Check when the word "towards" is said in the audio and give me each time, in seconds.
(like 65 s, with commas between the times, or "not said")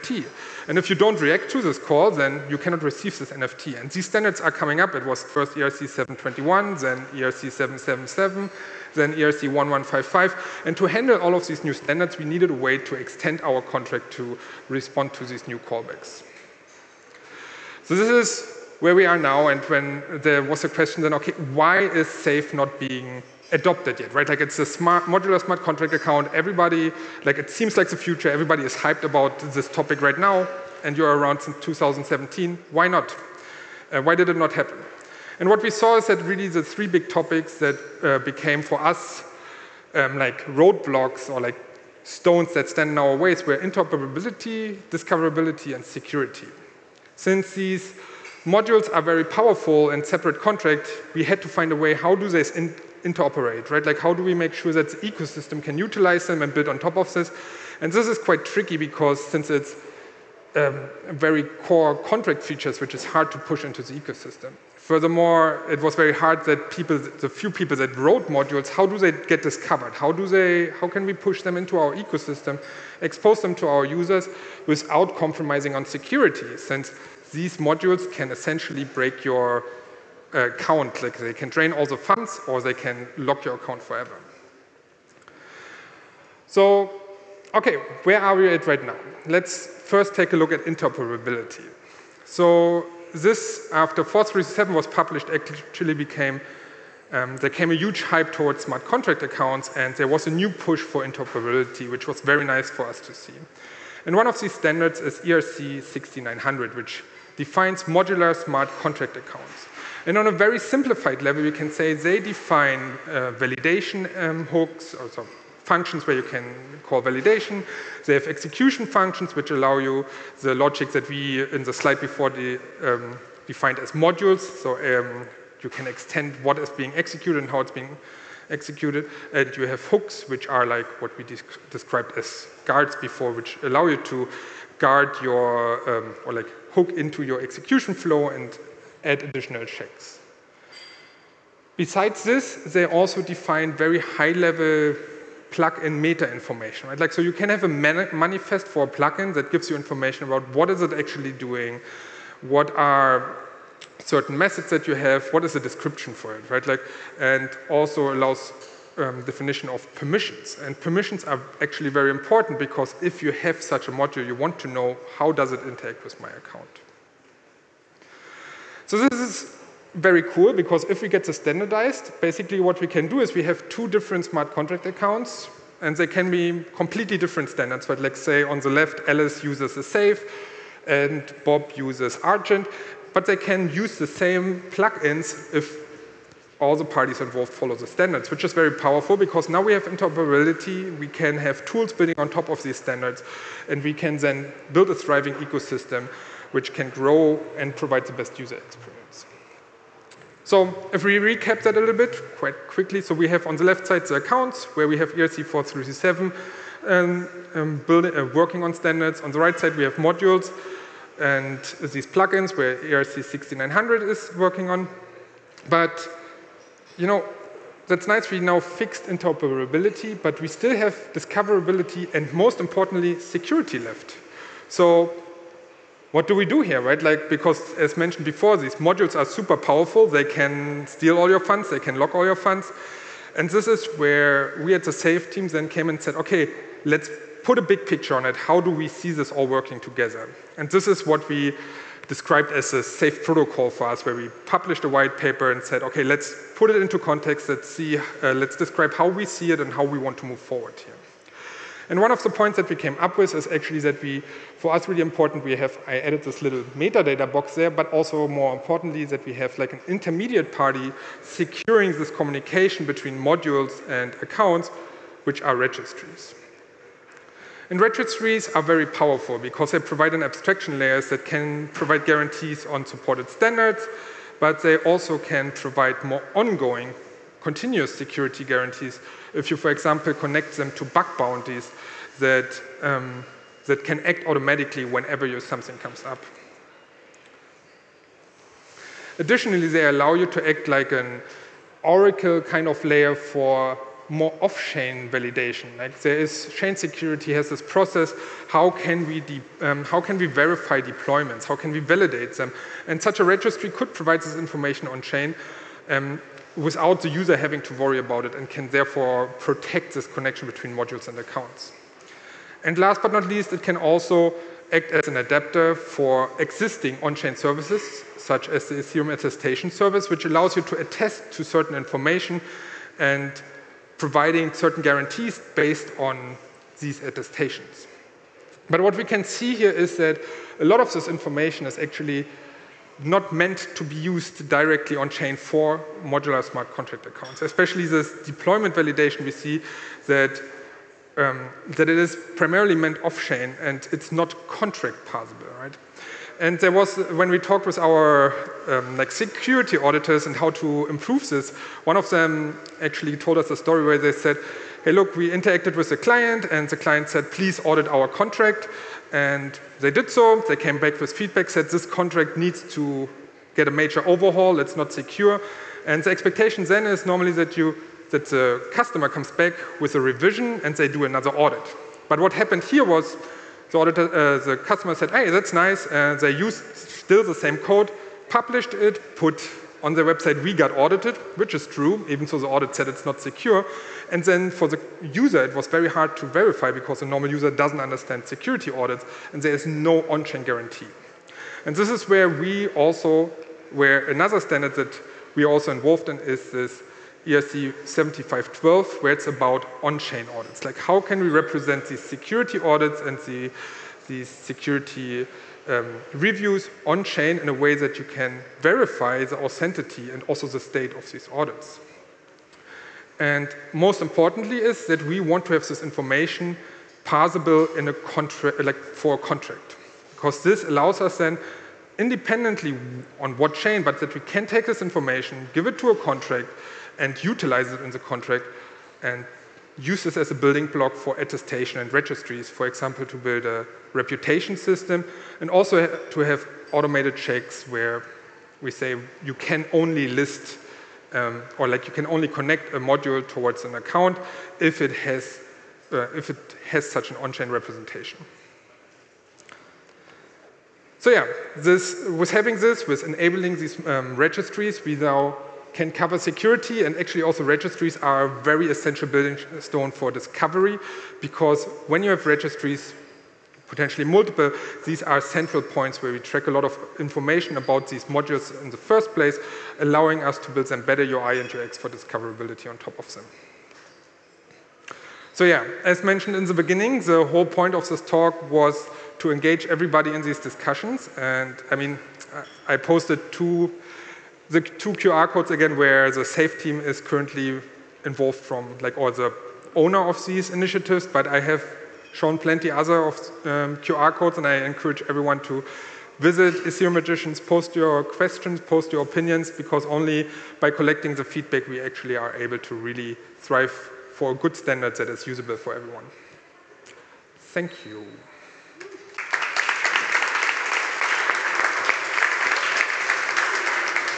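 98 s, 443 s.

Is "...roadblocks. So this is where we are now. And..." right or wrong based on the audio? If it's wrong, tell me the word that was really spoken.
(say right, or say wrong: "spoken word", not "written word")
wrong: "callbacks", not "roadblocks".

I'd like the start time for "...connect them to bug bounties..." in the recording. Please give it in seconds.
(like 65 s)
280 s.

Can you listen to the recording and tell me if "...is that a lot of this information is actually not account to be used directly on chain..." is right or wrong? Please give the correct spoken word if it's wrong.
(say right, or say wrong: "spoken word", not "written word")
wrong: "meant", not "account".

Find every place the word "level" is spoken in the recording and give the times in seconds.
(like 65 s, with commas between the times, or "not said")
111 s, 143 s.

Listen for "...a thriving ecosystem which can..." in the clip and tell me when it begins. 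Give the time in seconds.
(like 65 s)
194 s.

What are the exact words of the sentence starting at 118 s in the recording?
They have execution functions, which allow you the logic that we, in the slide before, the, um, defined as modules.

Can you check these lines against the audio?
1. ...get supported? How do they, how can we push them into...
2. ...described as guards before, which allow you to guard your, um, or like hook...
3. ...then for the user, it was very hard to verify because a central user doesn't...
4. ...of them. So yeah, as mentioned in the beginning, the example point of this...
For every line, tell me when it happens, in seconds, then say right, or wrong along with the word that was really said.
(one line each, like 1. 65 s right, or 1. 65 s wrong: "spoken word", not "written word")
1. 69 s wrong: "discovered", not "supported"
2. 131 s right
3. 384 s wrong: "normal", not "central"
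4. 472 s wrong: "whole", not "example".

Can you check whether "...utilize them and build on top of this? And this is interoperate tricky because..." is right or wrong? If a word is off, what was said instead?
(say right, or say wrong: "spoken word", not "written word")
wrong: "quite", not "interoperate".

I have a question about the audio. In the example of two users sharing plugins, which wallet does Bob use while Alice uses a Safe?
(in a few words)
Argent.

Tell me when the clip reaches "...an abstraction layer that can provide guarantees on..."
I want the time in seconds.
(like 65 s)
270 s.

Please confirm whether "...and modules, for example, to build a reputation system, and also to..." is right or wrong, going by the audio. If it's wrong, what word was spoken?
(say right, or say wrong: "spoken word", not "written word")
wrong: "registries", not "modules".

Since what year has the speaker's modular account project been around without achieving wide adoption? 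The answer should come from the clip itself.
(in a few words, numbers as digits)
2017.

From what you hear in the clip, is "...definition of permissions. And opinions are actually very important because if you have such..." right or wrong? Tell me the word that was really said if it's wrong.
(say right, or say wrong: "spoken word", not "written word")
wrong: "permissions", not "opinions".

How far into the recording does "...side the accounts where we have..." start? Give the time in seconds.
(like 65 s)
203 s.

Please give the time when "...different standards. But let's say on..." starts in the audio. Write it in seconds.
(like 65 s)
177 s.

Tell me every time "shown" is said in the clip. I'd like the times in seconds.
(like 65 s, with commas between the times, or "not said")
492 s.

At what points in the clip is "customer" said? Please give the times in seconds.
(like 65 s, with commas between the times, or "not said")
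368 s, 374 s.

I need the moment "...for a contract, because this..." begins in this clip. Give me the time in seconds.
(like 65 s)
418 s.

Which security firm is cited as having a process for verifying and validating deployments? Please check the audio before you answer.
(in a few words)
ChainSecurity.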